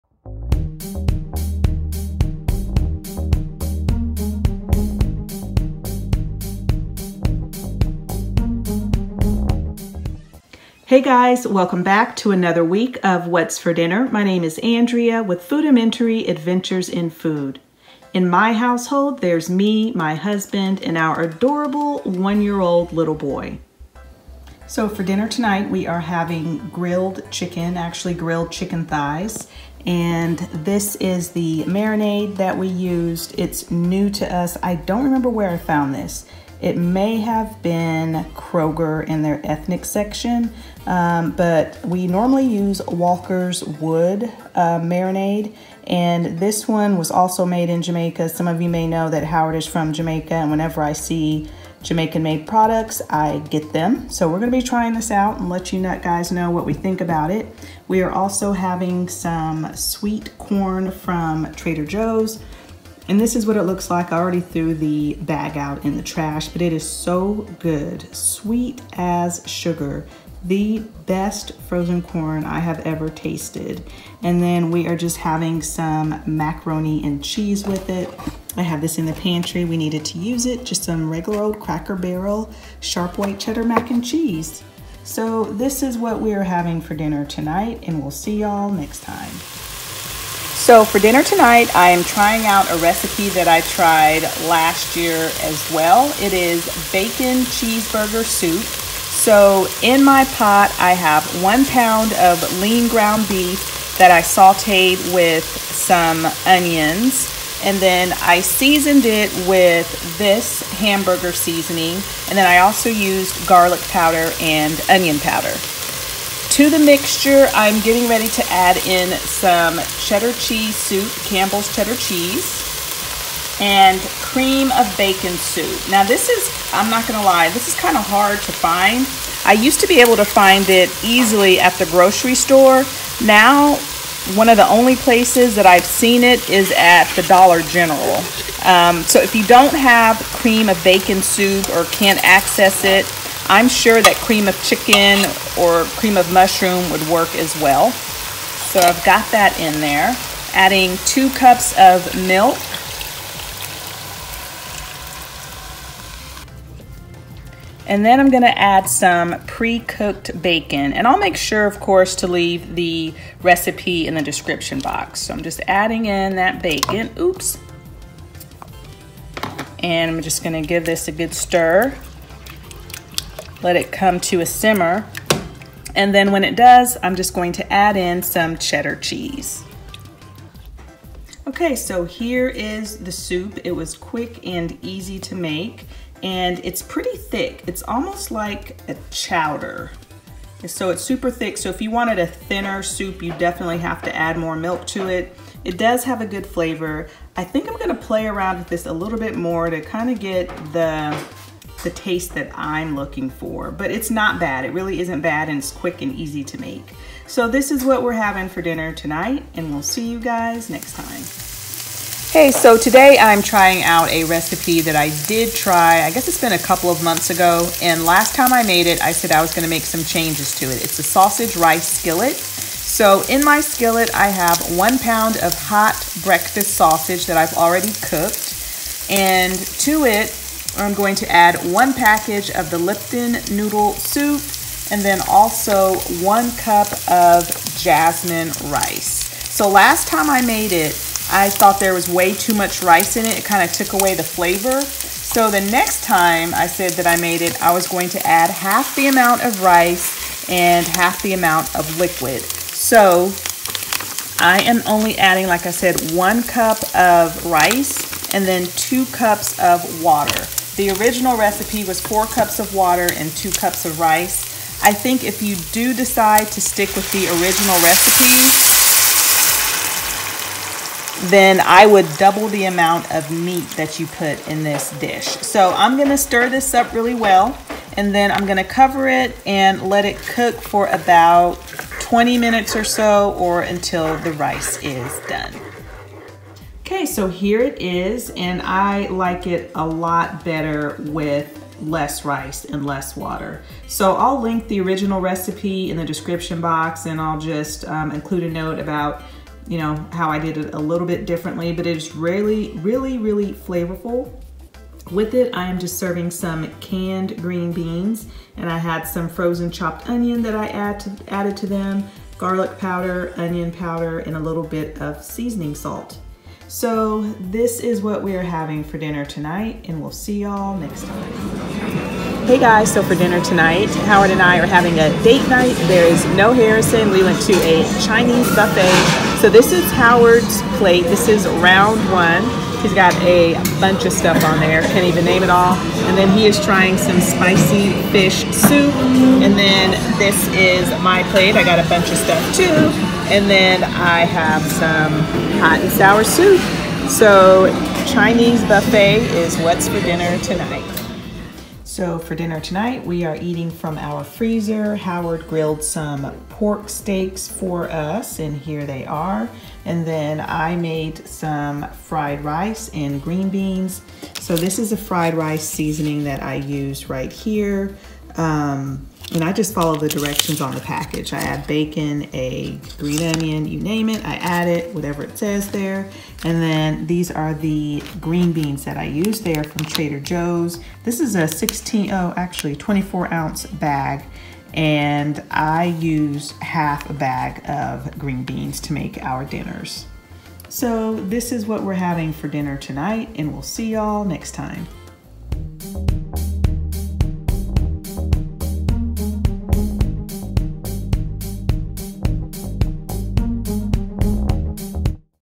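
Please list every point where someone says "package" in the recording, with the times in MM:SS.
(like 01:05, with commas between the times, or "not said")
03:51, 06:10.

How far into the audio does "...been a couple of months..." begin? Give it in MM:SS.
03:36.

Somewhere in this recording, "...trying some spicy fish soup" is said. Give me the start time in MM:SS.
05:36.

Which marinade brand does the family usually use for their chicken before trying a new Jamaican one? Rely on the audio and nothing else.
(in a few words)
Walkerswood.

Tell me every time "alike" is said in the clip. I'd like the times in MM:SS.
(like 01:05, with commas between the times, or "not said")
not said.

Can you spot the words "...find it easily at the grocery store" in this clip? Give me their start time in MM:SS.
02:10.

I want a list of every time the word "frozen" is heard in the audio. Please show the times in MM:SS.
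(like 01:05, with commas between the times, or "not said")
01:11, 05:09.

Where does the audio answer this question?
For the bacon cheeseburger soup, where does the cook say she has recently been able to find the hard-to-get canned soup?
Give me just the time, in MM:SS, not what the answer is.
02:17.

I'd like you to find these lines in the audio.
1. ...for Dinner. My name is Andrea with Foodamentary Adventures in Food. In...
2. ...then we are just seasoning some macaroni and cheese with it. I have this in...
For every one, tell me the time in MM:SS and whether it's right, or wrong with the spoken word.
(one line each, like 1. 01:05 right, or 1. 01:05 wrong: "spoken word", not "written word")
1. 00:13 right
2. 01:14 wrong: "having", not "seasoning".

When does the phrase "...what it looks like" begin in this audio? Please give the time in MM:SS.
01:03.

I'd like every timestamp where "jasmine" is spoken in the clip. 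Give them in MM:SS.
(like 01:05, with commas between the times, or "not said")
03:57.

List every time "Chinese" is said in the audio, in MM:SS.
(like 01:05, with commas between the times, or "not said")
05:28, 05:48.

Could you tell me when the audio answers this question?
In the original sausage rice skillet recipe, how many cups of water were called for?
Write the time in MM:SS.
04:21.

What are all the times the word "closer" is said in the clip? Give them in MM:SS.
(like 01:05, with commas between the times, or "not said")
not said.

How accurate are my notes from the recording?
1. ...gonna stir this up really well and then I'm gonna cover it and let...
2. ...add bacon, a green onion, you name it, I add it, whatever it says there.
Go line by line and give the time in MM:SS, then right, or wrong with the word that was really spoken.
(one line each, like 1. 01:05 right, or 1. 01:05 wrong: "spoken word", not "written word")
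1. 04:35 right
2. 06:11 right.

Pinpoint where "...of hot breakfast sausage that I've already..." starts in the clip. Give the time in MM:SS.
03:45.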